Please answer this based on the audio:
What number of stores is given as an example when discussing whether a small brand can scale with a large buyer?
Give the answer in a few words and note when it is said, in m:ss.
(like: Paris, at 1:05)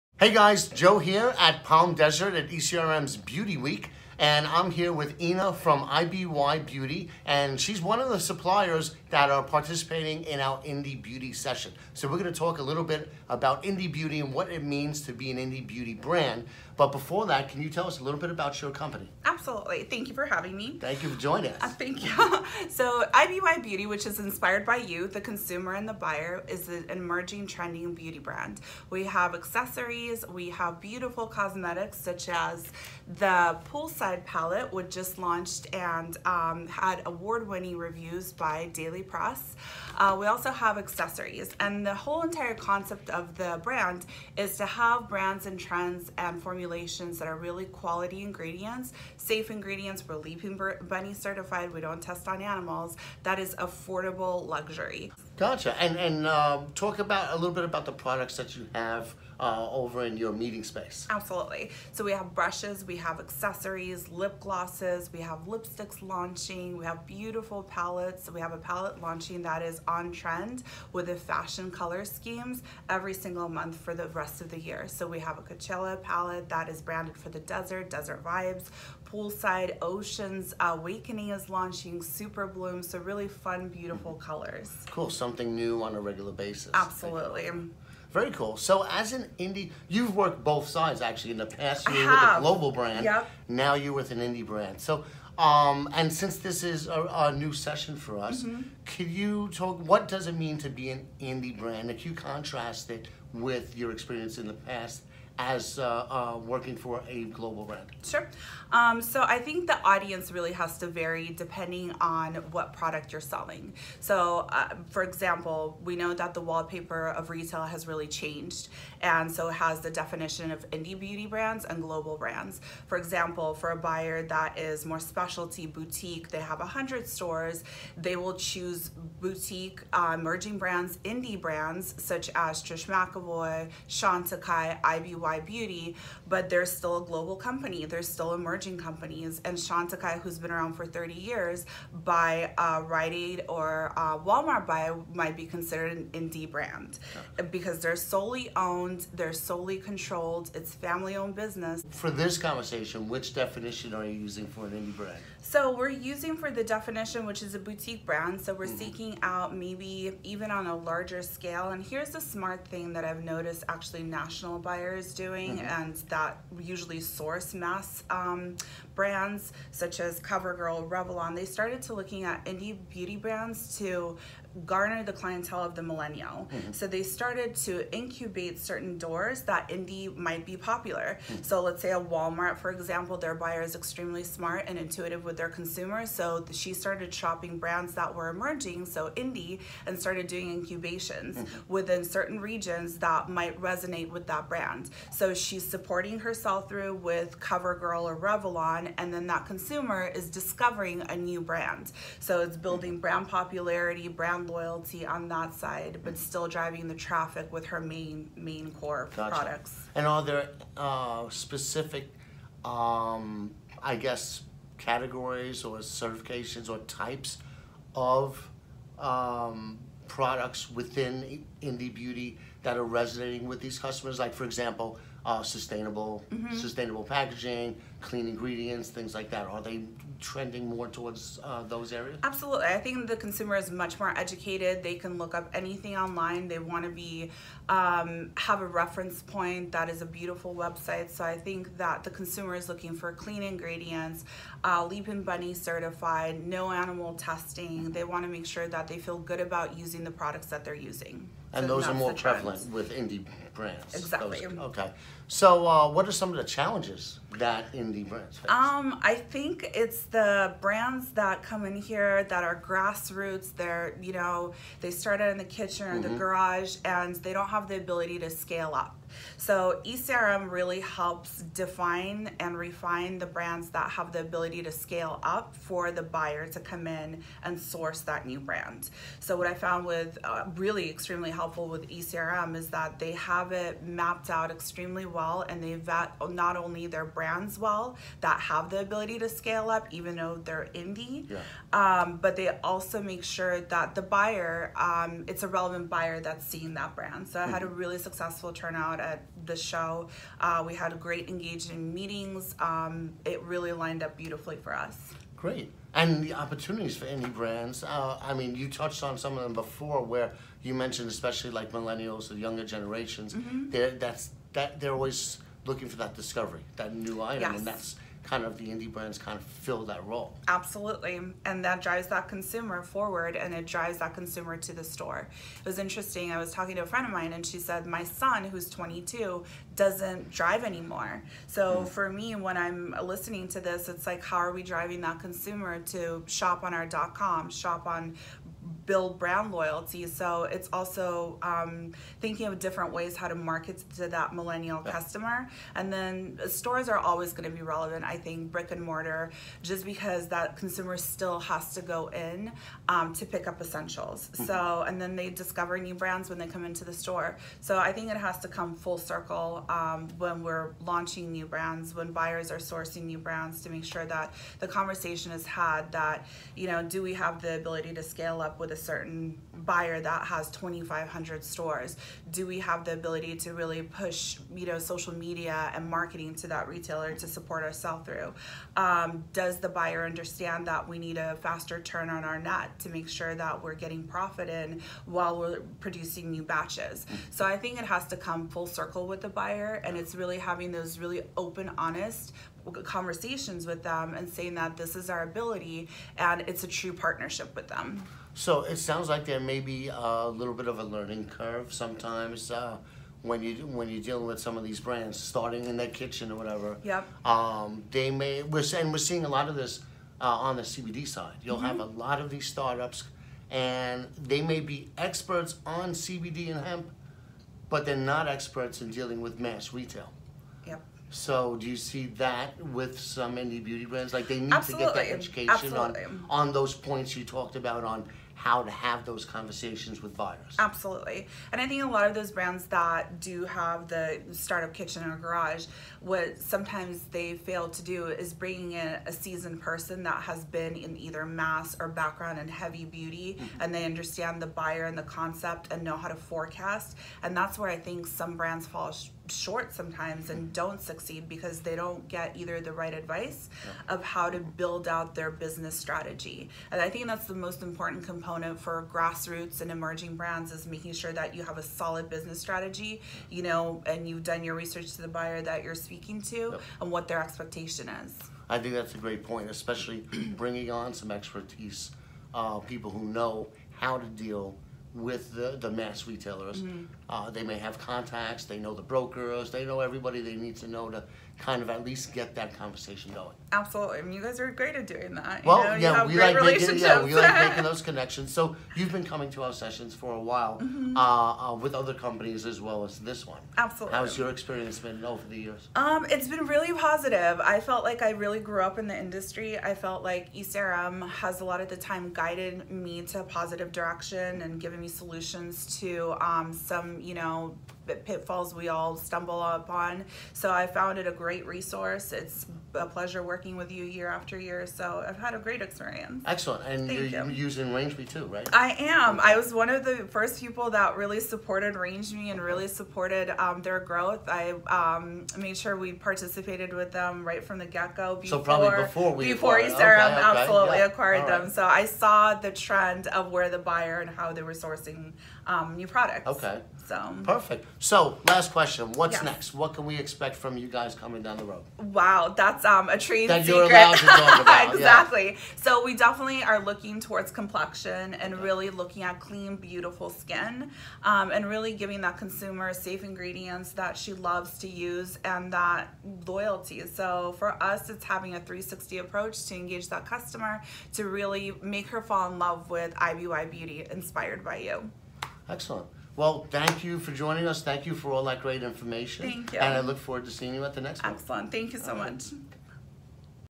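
2,500, at 6:10.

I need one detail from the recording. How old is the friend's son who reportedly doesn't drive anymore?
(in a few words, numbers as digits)
22.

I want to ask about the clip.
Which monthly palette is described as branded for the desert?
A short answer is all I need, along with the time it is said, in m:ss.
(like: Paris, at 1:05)
Coachella palette, at 1:15.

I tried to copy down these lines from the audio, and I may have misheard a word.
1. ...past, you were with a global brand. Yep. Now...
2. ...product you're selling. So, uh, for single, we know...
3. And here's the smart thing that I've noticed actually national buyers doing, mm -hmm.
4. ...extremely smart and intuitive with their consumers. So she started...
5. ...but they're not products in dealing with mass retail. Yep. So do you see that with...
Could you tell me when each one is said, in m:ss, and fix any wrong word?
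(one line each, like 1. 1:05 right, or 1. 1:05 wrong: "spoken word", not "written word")
1. 1:31 right
2. 1:52 wrong: "example", not "single"
3. 2:41 right
4. 3:03 right
5. 6:57 wrong: "experts", not "products".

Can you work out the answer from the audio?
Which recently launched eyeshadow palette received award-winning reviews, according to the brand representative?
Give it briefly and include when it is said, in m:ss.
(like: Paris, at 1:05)
Poolside Palette, at 0:33.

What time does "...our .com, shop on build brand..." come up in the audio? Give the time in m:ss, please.
5:36.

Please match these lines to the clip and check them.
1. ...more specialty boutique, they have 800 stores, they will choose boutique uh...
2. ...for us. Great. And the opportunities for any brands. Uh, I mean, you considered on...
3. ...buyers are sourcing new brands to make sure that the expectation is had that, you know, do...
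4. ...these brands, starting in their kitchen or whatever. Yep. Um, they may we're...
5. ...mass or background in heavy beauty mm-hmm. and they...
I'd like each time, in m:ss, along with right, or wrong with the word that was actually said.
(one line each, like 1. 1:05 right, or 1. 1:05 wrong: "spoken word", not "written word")
1. 2:04 wrong: "100", not "800"
2. 5:04 wrong: "touched", not "considered"
3. 6:02 wrong: "conversation", not "expectation"
4. 6:44 right
5. 7:21 right.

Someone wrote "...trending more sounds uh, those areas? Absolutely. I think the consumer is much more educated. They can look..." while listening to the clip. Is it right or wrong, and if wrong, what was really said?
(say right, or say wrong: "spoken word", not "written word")
wrong: "towards", not "sounds".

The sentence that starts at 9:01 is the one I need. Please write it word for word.
Wow, that's that's um, a trade that secret.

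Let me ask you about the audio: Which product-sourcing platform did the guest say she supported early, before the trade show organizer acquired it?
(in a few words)
RangeMe.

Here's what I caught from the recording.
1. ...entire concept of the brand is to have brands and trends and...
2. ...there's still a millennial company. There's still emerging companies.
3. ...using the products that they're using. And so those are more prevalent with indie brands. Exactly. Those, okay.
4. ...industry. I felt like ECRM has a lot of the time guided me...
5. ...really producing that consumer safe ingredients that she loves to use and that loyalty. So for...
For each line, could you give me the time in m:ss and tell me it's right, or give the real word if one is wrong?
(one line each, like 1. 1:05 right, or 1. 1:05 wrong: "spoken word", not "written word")
1. 0:42 right
2. 2:16 wrong: "global", not "millennial"
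3. 4:09 right
4. 8:19 right
5. 9:11 wrong: "giving", not "producing".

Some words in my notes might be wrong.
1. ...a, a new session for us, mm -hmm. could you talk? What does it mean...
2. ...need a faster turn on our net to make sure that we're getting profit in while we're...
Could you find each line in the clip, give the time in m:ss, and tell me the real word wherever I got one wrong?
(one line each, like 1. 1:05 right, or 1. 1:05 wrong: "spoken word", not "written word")
1. 1:36 right
2. 6:20 right.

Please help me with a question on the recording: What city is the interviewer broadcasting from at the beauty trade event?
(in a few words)
Palm Desert.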